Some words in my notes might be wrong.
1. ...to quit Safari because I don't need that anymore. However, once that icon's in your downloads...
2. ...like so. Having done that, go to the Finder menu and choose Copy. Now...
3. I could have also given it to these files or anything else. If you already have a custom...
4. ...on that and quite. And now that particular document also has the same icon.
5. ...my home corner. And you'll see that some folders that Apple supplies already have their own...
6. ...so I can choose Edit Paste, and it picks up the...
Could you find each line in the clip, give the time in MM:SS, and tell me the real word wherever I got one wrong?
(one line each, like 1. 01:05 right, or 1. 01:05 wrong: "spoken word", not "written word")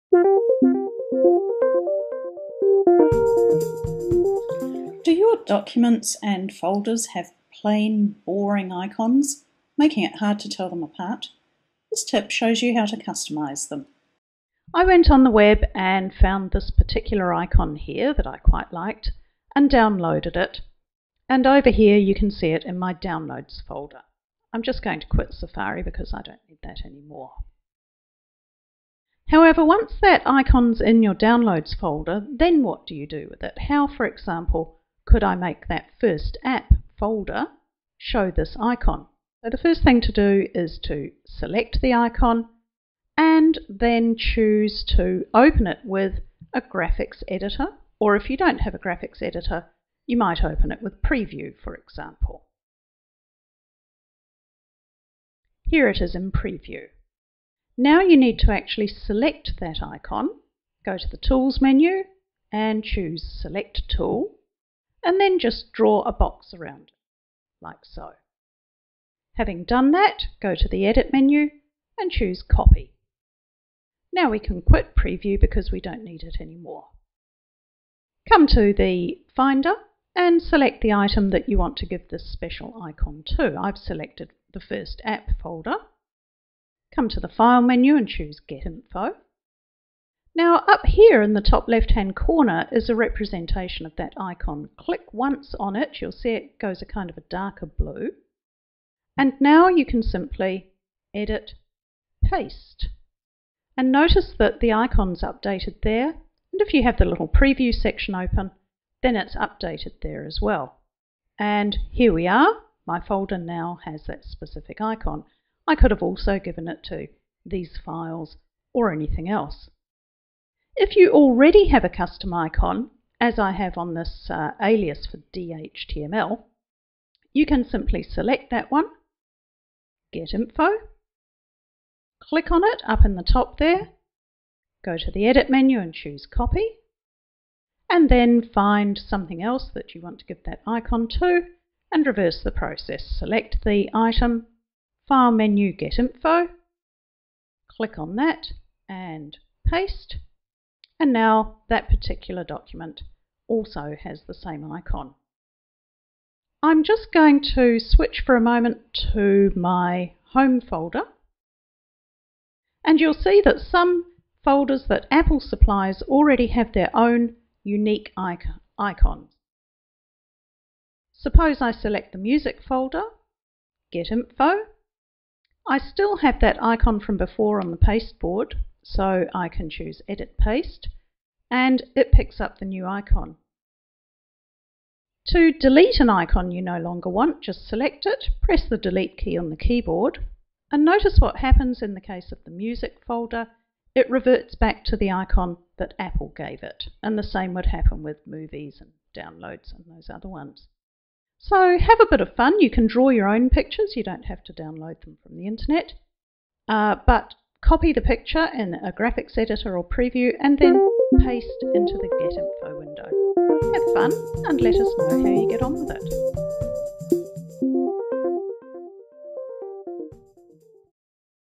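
1. 00:25 right
2. 01:07 wrong: "Edit", not "Finder"
3. 01:55 right
4. 02:27 wrong: "paste", not "quite"
5. 02:39 wrong: "folder", not "corner"
6. 02:58 right.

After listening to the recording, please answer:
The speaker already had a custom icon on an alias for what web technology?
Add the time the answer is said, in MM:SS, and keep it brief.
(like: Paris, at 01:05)
DHTML, at 02:05.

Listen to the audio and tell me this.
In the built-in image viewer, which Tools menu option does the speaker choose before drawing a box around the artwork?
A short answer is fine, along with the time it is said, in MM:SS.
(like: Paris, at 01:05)
Select Tool, at 01:03.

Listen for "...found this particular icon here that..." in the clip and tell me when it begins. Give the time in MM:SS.
00:16.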